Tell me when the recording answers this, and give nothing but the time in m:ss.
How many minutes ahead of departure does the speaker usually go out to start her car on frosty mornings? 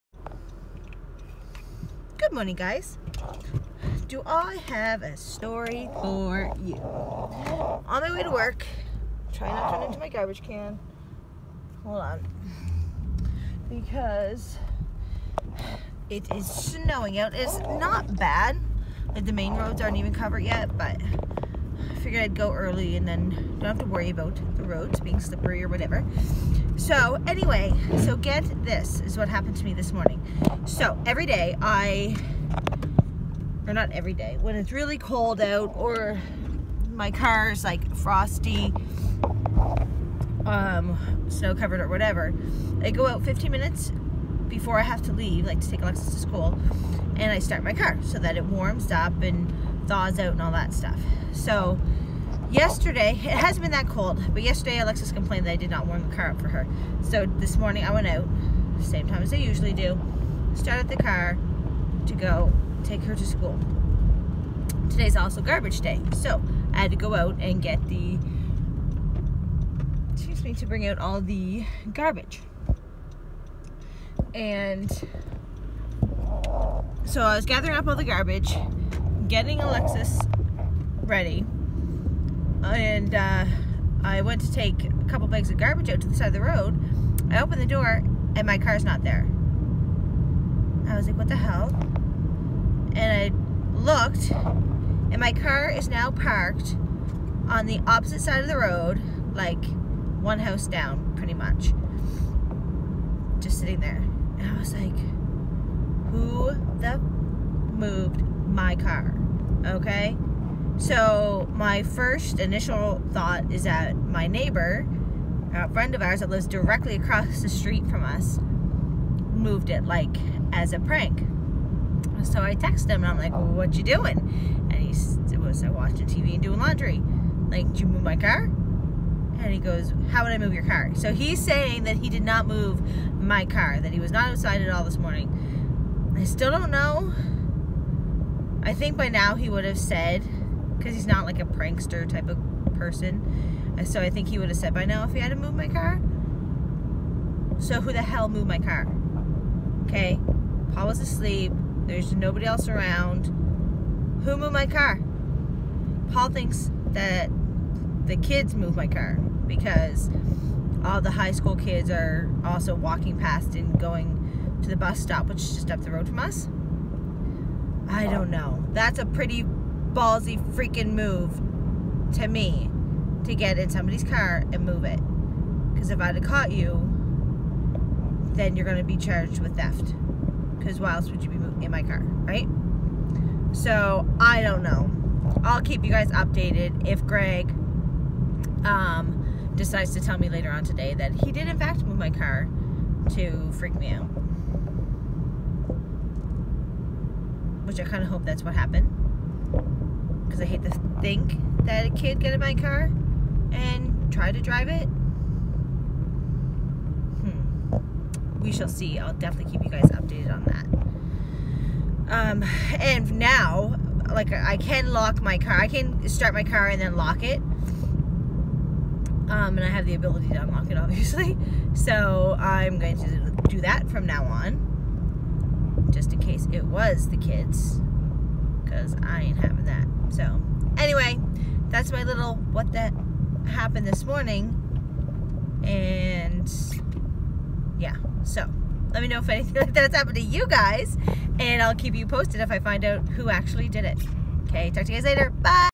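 0:43.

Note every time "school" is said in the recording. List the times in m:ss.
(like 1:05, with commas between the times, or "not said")
0:46, 1:03, 2:41.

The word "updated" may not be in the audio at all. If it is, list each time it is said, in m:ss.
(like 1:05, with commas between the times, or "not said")
3:06, 3:29.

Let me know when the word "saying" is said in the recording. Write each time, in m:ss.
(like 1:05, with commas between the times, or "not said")
2:11.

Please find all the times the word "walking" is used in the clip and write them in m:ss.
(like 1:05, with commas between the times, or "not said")
2:42.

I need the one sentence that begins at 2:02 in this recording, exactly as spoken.
So I text him and I'm like, well, what you doing?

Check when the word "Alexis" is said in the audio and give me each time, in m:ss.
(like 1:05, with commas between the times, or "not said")
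0:45, 0:54, 1:19.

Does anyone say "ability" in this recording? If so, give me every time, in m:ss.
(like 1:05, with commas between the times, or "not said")
3:39.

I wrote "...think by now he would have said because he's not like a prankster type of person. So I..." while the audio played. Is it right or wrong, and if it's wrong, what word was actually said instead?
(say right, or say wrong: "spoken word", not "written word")
right.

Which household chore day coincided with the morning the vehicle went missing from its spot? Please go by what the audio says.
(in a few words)
Garbage day.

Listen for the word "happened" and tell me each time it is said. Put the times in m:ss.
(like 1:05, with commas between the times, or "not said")
0:29, 3:18, 3:53, 3:59.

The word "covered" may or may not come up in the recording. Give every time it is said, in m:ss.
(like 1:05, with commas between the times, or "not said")
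0:20, 0:41.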